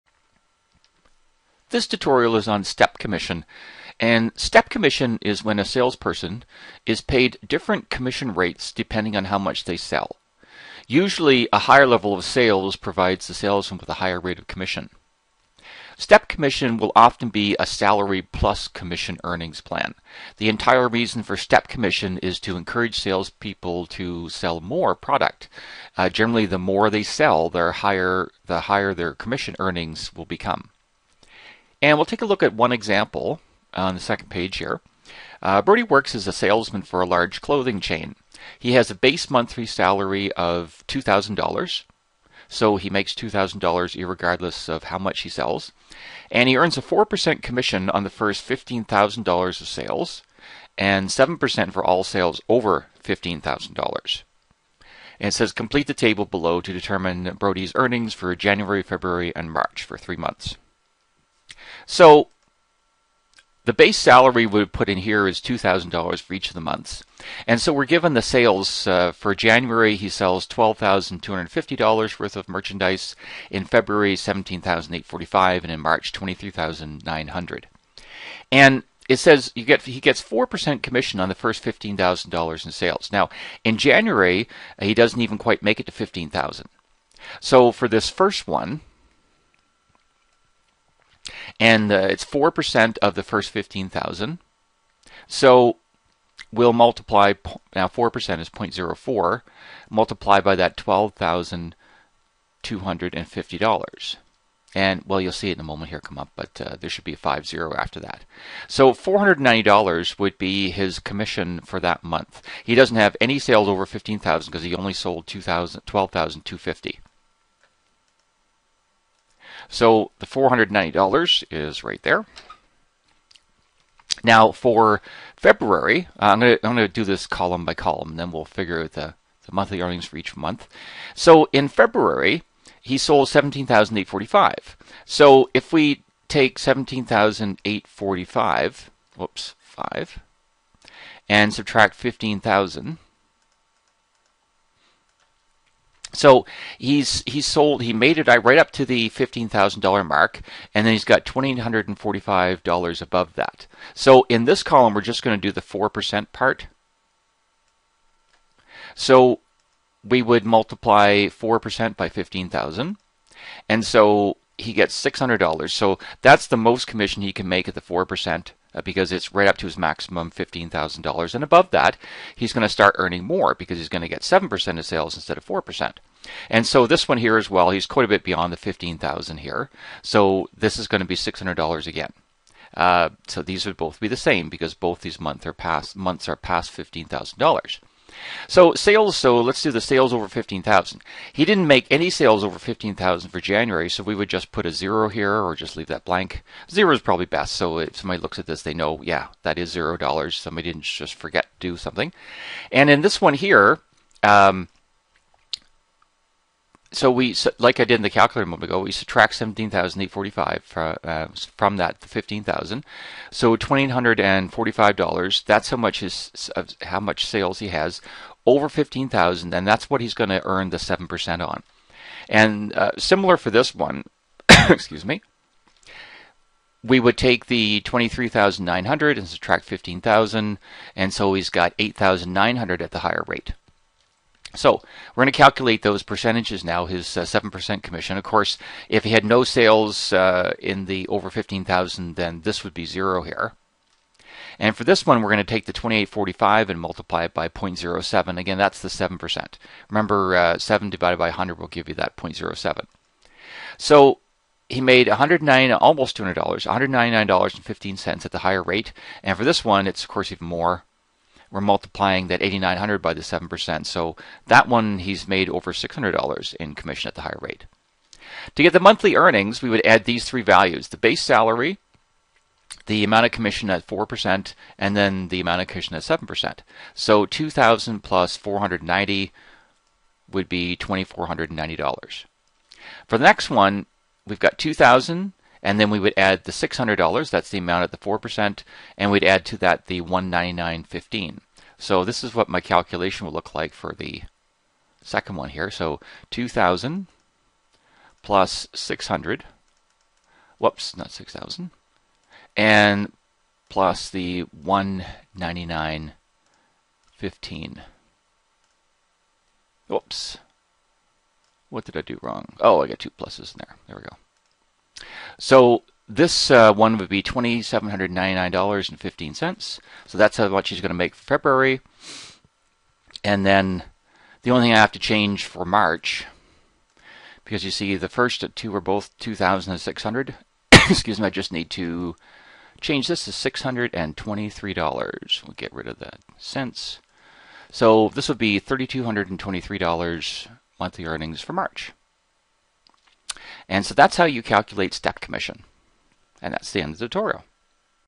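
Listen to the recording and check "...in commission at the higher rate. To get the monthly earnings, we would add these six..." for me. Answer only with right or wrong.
wrong.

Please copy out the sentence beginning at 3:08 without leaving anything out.
So sales, so let's do the sales over 15,000.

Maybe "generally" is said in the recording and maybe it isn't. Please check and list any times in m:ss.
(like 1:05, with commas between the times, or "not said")
0:26.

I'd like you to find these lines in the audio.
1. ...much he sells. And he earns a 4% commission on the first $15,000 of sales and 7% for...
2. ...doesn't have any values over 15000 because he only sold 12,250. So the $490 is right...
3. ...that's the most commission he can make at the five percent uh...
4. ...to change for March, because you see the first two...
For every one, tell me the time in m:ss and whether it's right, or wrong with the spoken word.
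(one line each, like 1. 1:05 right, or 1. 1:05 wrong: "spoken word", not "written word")
1. 0:44 right
2. 1:52 wrong: "sales", not "values"
3. 2:46 wrong: "four", not "five"
4. 5:24 right.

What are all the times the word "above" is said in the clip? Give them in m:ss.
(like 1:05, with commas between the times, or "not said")
2:33, 2:51.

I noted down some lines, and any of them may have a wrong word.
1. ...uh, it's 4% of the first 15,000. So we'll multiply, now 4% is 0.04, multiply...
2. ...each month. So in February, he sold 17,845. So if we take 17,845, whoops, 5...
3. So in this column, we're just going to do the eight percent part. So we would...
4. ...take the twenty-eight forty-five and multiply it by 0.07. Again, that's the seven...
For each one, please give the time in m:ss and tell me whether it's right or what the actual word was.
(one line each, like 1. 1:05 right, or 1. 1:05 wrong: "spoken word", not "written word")
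1. 1:31 right
2. 2:10 right
3. 2:33 wrong: "four", not "eight"
4. 4:05 right.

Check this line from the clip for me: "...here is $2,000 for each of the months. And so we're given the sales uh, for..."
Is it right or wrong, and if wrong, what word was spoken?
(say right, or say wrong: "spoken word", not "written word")
right.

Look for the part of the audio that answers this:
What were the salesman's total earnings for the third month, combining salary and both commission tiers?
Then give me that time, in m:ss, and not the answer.
5:38.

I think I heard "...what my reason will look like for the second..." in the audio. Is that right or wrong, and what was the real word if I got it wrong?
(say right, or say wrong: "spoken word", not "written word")
wrong: "calculation", not "reason".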